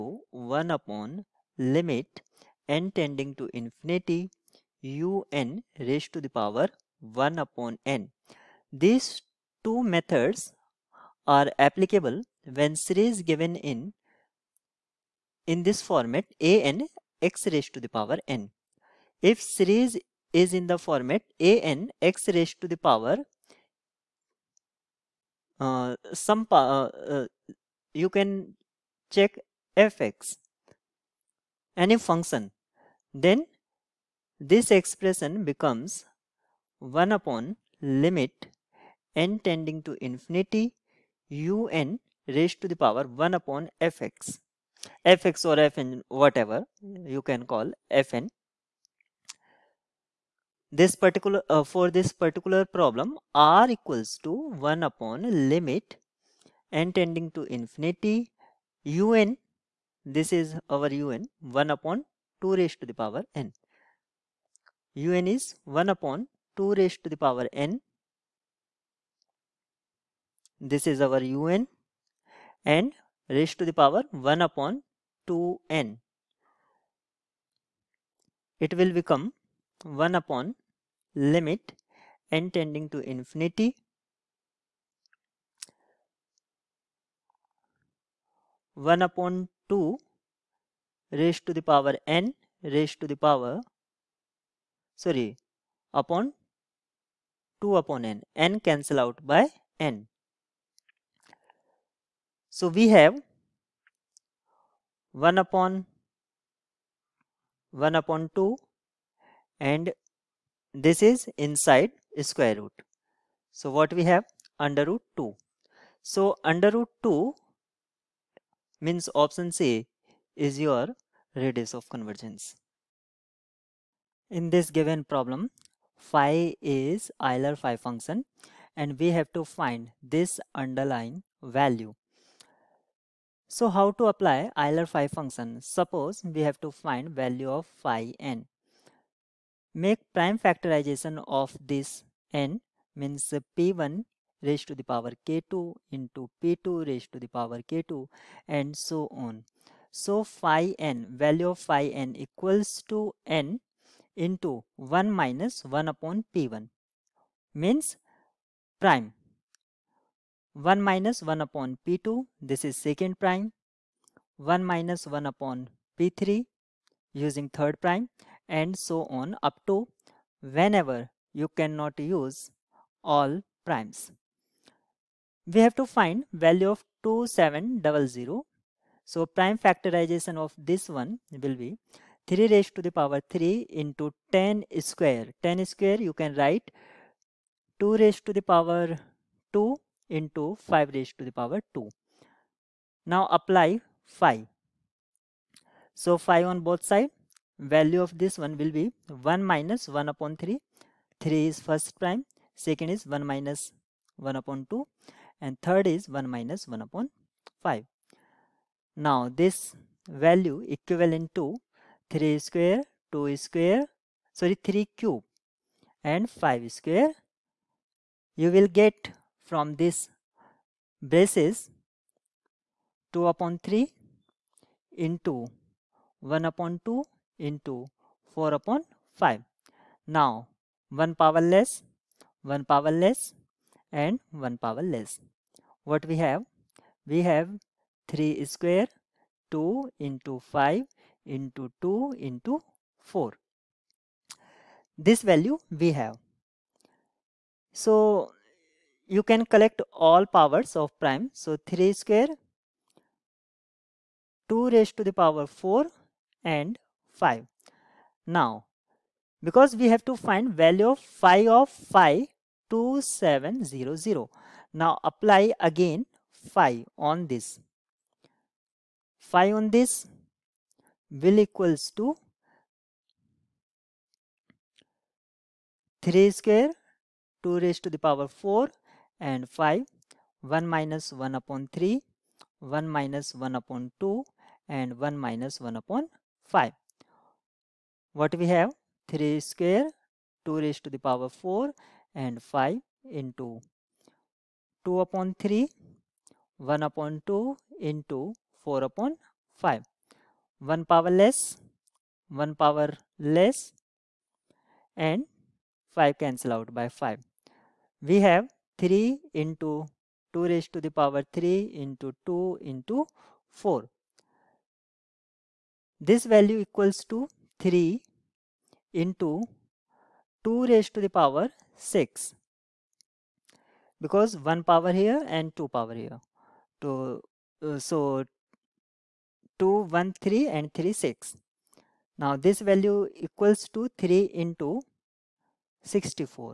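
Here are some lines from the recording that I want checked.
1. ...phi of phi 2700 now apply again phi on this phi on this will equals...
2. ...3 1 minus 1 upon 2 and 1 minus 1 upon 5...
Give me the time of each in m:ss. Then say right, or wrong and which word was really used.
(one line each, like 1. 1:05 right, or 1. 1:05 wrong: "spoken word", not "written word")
1. 4:21 right
2. 4:41 right.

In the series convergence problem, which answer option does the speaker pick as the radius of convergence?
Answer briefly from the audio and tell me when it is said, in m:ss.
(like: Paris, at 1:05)
Option C, at 1:59.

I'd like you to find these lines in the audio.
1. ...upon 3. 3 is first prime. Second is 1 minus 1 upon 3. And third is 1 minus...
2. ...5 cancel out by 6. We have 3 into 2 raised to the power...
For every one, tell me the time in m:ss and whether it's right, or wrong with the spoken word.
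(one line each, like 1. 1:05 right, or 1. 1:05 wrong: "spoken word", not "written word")
1. 3:20 wrong: "2", not "3"
2. 5:05 wrong: "5", not "6".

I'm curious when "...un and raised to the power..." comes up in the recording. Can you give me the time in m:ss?
1:11.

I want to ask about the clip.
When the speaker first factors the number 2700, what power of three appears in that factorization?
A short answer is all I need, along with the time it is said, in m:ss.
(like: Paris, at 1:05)
3 cubed, at 3:02.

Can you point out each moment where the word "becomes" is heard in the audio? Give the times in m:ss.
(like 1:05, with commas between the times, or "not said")
0:35, 1:18.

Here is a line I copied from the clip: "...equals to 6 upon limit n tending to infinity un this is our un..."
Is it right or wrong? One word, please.
wrong.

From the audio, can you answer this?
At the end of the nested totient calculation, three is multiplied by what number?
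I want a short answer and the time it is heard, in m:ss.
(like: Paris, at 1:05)
64, at 5:35.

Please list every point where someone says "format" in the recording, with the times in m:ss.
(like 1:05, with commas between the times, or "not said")
0:15, 0:20.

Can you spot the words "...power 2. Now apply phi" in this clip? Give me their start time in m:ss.
3:11.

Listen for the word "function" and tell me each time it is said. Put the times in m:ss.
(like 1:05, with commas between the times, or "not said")
0:31, 2:07, 2:15.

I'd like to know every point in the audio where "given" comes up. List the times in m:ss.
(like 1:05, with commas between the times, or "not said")
0:13, 2:04.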